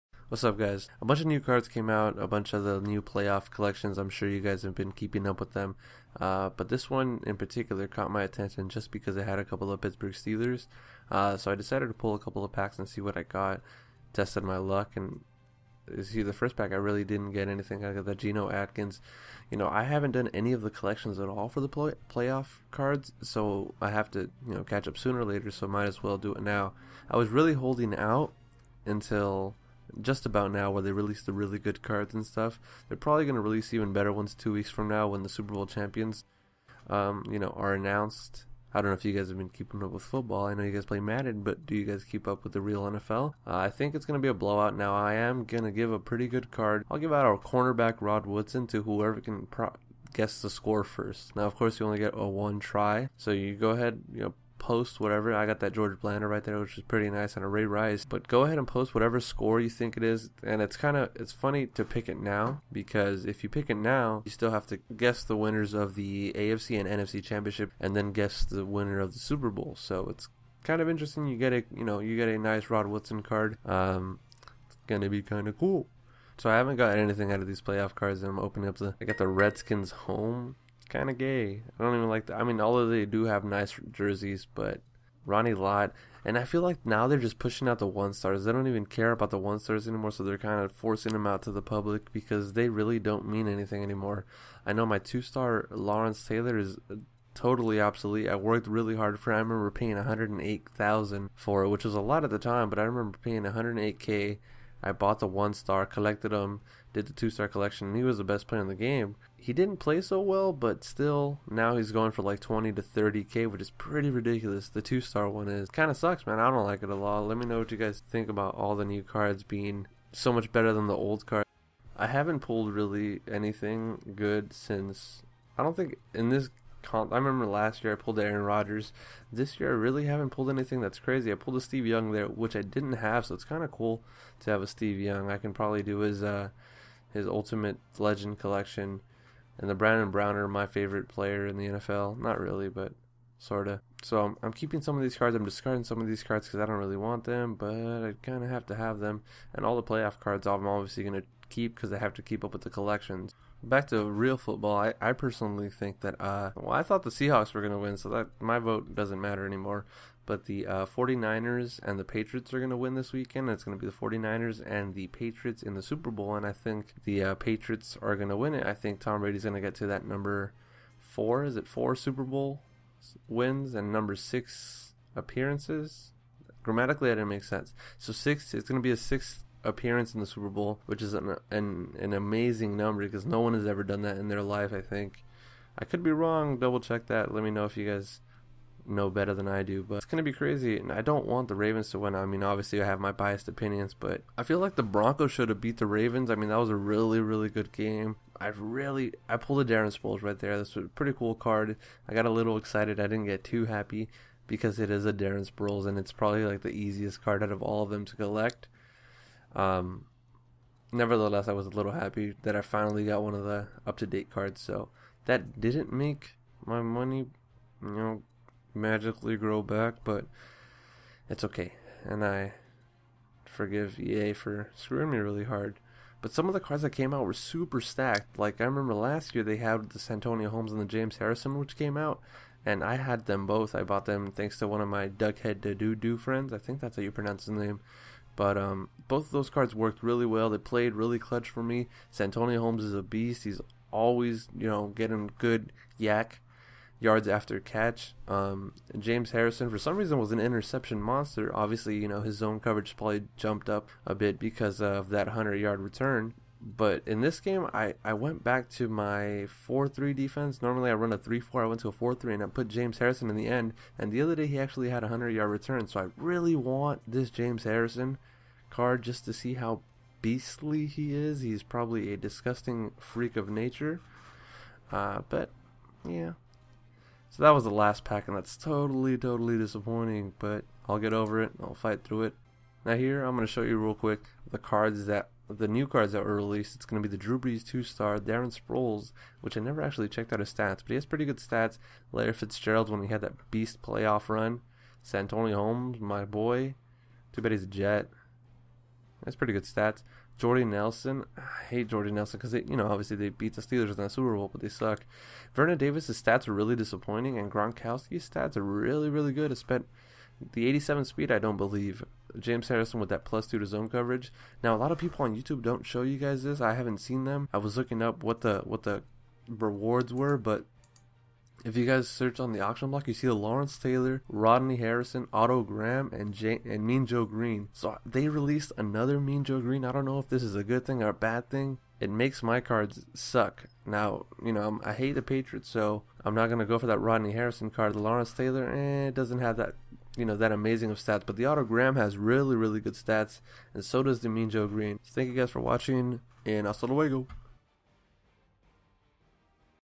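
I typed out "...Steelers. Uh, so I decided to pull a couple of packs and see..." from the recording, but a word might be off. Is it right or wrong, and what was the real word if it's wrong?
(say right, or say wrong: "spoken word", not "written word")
right.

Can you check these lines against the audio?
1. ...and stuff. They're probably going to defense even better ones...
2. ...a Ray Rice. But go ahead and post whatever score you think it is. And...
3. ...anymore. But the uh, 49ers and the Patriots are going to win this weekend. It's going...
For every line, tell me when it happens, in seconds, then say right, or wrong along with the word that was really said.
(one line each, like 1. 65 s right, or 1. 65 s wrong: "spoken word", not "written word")
1. 32 s wrong: "release", not "defense"
2. 57 s right
3. 159 s right.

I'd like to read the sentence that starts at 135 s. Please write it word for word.
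I can probably do his uh, his Ultimate Legend collection, and the Brandon Browner, my favorite player in the NFL.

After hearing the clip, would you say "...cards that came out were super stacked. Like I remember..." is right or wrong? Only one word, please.
right.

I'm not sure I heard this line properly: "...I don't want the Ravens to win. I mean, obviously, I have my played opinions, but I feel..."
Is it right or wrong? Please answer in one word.
wrong.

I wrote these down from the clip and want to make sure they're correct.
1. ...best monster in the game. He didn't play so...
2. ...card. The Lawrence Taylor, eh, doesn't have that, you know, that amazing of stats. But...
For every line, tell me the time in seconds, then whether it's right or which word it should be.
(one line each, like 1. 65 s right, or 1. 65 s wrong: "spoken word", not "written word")
1. 108 s wrong: "player", not "monster"
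2. 337 s right.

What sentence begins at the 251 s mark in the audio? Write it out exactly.
Obviously, you know, his zone coverage probably jumped up a bit because of that 100 yard return.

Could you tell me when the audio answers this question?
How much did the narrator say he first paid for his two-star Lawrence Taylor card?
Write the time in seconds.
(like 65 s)
99 s.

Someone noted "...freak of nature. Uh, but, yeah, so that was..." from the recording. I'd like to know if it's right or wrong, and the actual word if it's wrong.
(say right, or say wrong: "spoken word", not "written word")
right.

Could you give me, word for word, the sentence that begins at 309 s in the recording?
Spent the 87 speed, I don't believe.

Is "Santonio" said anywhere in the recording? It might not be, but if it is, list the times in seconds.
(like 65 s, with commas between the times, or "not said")
229 s, 242 s, 295 s.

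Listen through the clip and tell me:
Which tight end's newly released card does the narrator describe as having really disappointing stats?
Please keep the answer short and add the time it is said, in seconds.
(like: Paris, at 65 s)
Vernon Davis, at 305 s.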